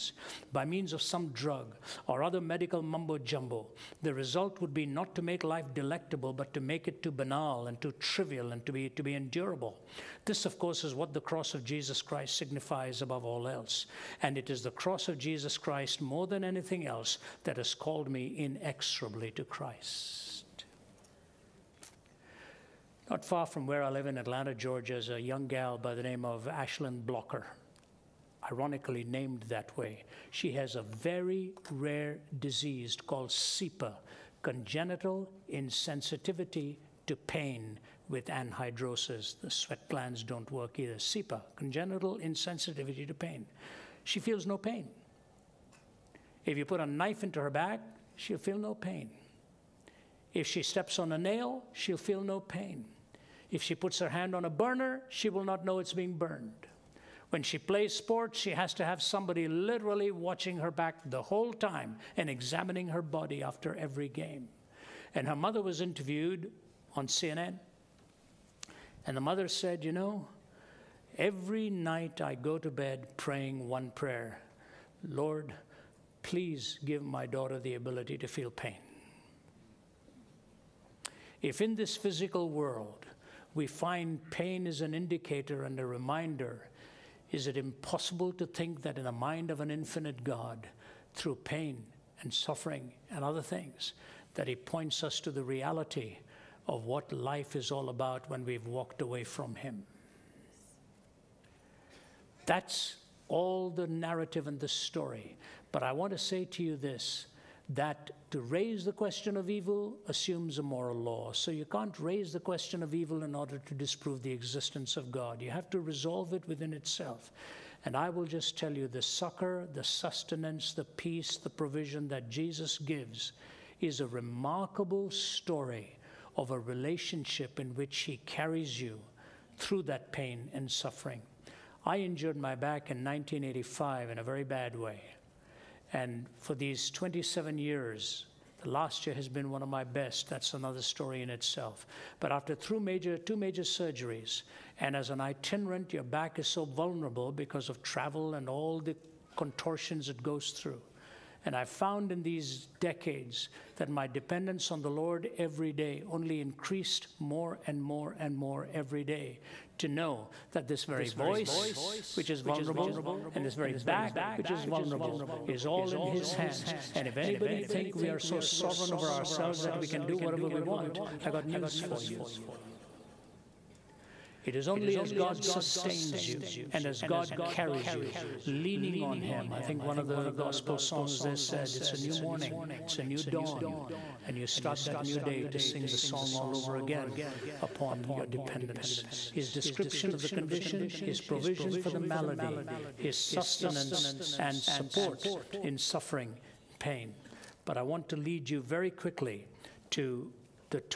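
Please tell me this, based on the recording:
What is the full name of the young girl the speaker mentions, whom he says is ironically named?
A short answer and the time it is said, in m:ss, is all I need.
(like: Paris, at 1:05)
Ashlyn Blocker, at 0:26.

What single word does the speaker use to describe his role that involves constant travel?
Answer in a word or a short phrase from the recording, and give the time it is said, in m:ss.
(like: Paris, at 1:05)
itinerant, at 2:25.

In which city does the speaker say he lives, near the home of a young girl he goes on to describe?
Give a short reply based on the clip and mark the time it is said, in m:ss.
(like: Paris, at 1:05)
Atlanta, at 0:24.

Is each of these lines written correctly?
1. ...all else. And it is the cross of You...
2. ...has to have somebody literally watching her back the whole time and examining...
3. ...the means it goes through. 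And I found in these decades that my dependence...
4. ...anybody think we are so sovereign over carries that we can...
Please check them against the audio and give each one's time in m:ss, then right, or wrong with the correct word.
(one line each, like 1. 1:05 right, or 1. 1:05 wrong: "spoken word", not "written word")
1. 0:13 wrong: "Jesus", not "You"
2. 0:58 right
3. 2:28 wrong: "contortions", not "means"
4. 2:47 wrong: "ourselves", not "carries".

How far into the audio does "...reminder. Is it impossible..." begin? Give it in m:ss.
1:25.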